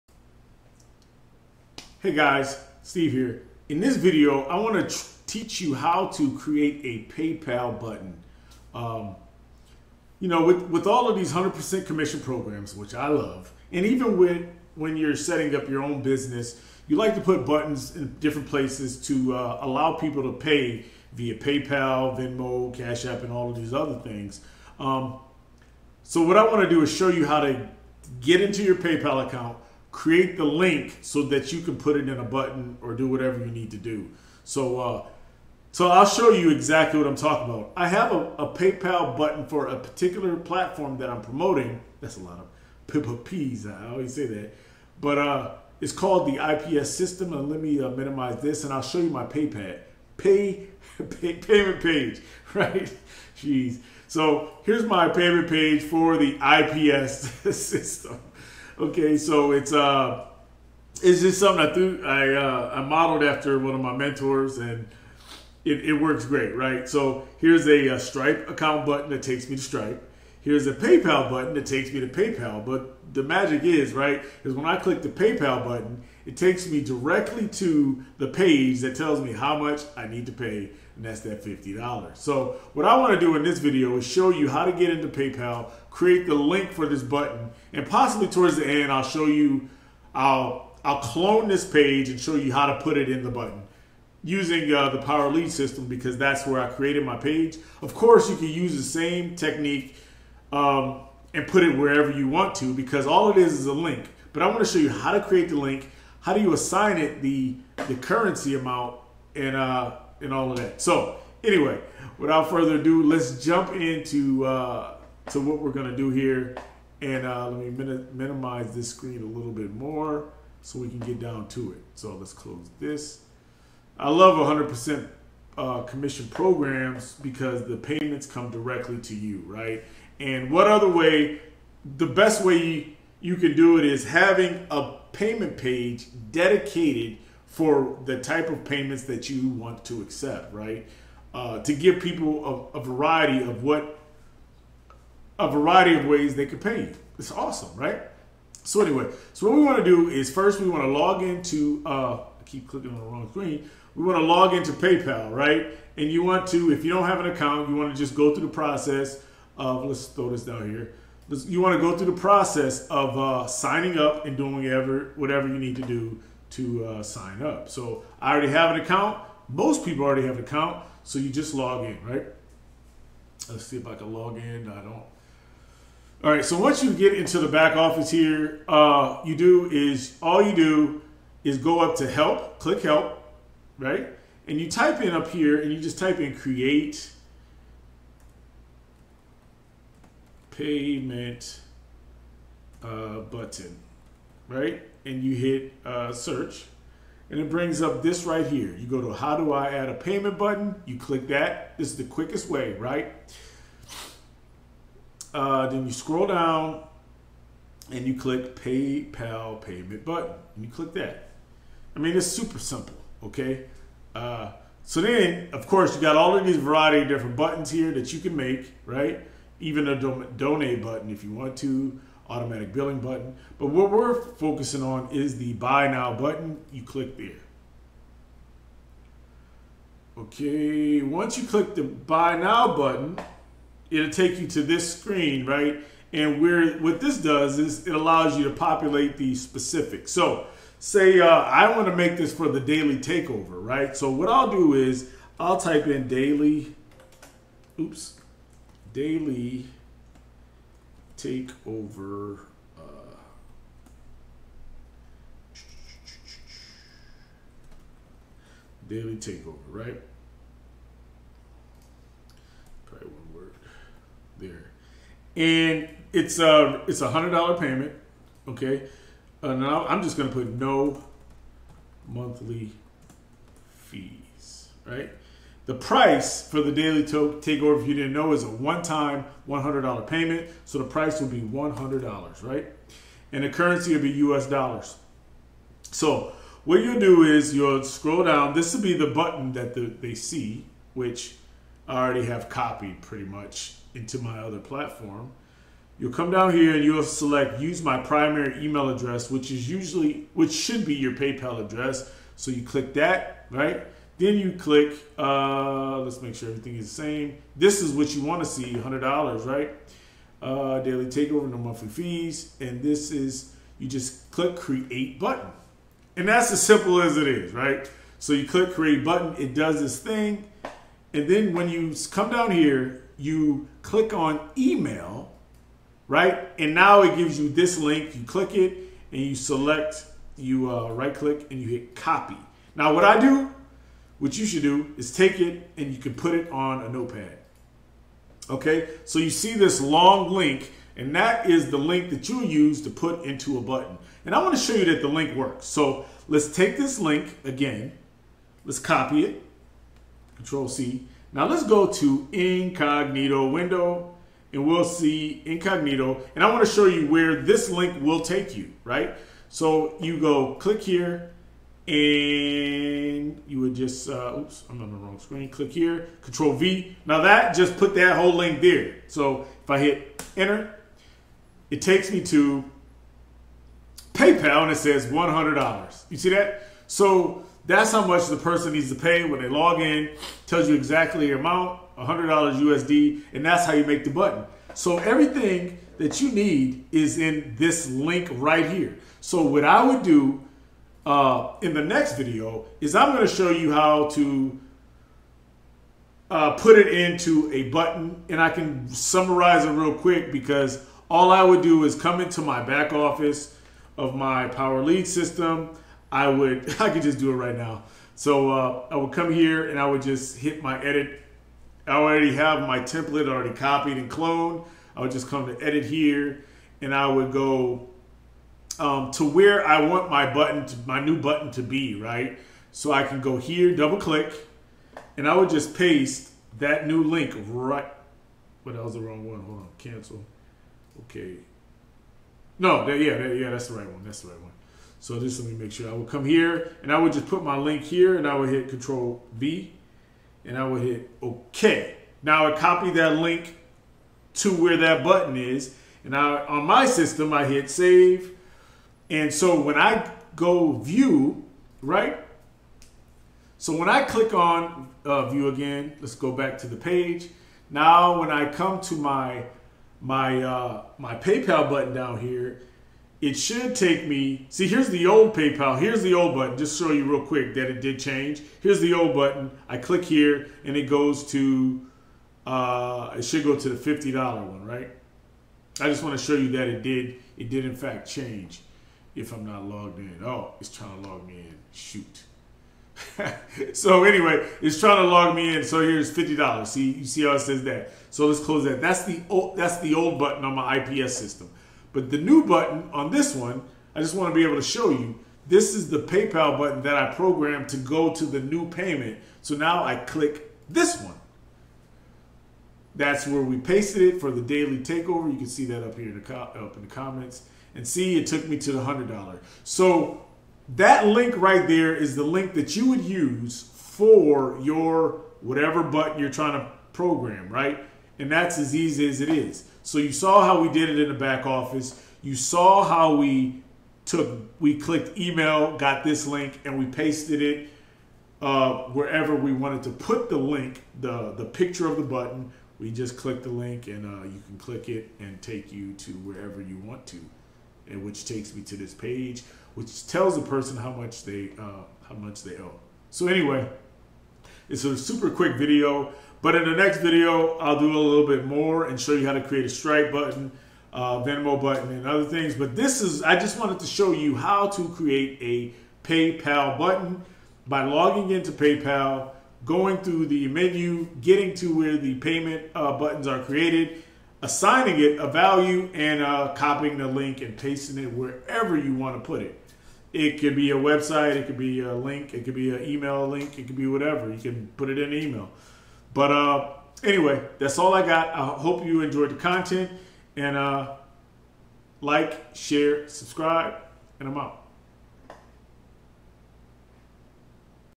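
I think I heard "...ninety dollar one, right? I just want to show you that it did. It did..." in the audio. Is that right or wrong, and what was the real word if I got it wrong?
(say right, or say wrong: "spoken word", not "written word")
wrong: "fifty", not "ninety".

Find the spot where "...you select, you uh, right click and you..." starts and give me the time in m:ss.
5:29.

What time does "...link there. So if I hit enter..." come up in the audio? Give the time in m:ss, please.
6:08.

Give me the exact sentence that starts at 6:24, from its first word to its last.
So everything that you need is in this link right here.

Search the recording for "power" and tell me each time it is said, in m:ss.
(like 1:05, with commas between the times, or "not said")
1:34, 6:44.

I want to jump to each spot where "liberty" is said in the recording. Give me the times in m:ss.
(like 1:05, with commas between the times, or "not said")
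not said.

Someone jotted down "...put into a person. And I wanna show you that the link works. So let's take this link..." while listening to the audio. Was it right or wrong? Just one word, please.
wrong.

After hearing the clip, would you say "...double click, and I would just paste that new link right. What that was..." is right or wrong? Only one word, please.
right.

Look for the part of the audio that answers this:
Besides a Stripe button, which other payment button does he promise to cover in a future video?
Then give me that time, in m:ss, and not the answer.
9:11.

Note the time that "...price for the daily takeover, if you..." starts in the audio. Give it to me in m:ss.
4:35.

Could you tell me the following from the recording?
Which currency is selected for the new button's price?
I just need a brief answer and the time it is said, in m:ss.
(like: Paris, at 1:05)
US dollars, at 4:44.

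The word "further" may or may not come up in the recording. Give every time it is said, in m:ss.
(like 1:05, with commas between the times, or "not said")
1:52.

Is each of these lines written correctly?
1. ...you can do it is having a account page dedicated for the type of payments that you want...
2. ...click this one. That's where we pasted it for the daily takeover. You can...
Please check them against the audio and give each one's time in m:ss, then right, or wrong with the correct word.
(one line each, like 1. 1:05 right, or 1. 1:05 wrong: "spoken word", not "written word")
1. 2:13 wrong: "payment", not "account"
2. 8:19 right.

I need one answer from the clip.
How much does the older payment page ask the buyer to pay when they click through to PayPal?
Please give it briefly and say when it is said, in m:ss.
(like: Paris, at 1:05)
$50, at 1:21.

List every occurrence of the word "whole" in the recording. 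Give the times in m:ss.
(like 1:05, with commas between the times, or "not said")
6:08.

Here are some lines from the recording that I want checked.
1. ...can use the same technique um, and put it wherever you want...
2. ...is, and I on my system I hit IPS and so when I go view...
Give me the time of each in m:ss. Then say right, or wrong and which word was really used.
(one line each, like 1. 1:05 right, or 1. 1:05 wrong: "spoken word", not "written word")
1. 1:38 right
2. 7:25 wrong: "Save", not "IPS".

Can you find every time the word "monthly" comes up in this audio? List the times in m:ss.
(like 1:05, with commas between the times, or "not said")
4:32, 5:11.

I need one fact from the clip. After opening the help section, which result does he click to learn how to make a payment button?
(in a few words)
How do I add a payment button.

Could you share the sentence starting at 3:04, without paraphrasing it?
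And you type in up here, and you just type in create payment uh, button right?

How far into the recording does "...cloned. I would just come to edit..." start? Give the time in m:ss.
6:54.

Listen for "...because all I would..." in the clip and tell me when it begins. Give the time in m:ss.
6:40.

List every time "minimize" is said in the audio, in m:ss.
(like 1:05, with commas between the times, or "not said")
0:47, 1:58.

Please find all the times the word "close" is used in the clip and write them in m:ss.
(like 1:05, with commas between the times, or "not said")
2:02, 8:08.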